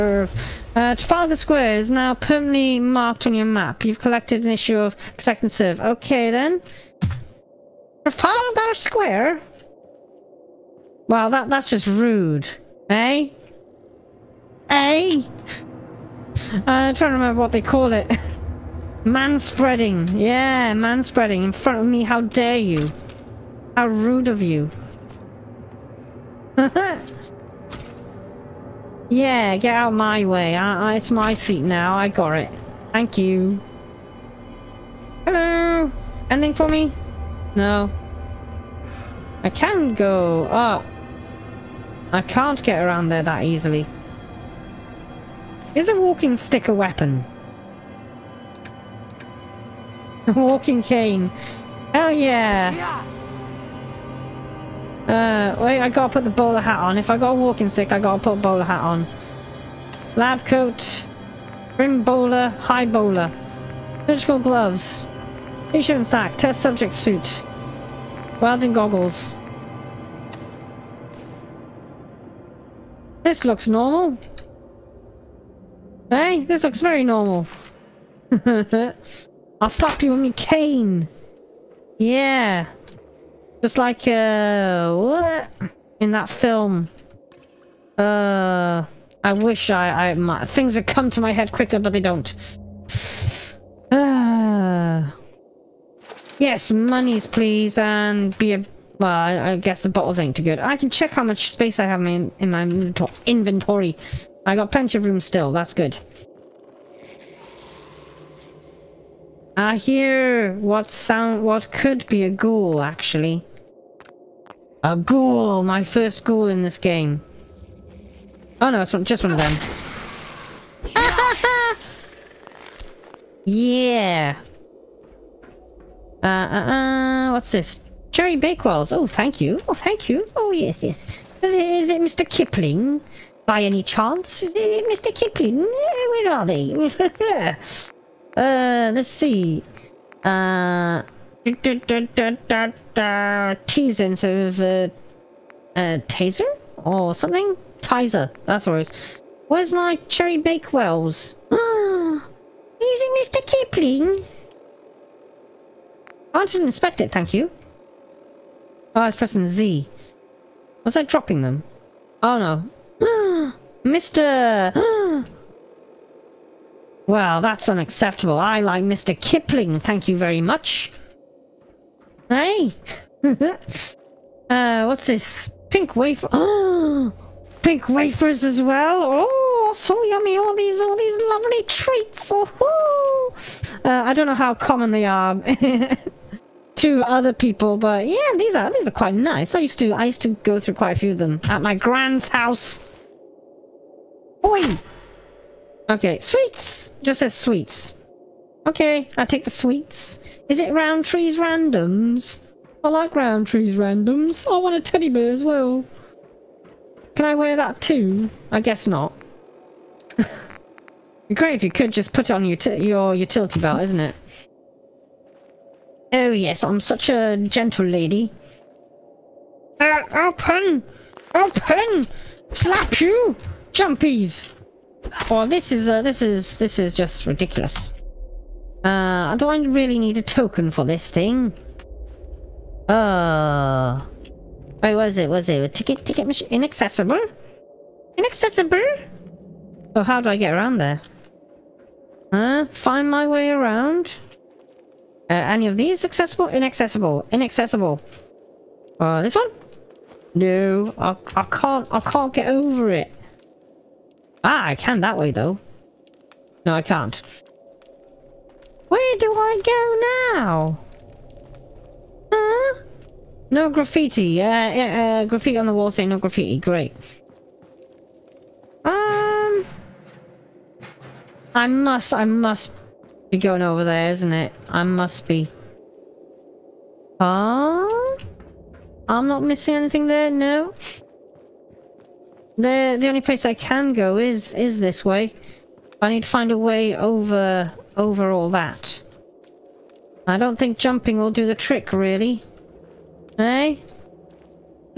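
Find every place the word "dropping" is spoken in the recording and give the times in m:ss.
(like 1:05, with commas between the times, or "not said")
2:41.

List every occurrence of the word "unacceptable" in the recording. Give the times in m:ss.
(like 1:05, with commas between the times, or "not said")
2:47.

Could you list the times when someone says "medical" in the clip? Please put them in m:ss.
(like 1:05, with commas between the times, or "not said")
not said.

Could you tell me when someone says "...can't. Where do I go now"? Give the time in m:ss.
4:16.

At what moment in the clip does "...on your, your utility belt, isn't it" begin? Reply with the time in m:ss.
3:32.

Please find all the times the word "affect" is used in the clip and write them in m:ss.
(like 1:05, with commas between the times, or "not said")
not said.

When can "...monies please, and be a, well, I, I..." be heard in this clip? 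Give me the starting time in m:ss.
1:36.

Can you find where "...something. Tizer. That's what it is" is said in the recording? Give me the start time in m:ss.
2:27.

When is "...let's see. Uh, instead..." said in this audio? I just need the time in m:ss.
2:18.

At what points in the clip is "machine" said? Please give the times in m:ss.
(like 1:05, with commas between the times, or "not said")
3:56.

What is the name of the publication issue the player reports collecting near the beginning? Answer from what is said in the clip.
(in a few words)
Protect and Serve.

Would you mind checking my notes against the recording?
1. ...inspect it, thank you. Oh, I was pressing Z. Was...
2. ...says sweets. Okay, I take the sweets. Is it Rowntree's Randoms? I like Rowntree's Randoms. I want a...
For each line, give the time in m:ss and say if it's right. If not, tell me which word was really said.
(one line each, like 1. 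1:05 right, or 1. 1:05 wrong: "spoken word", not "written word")
1. 2:36 right
2. 3:17 right.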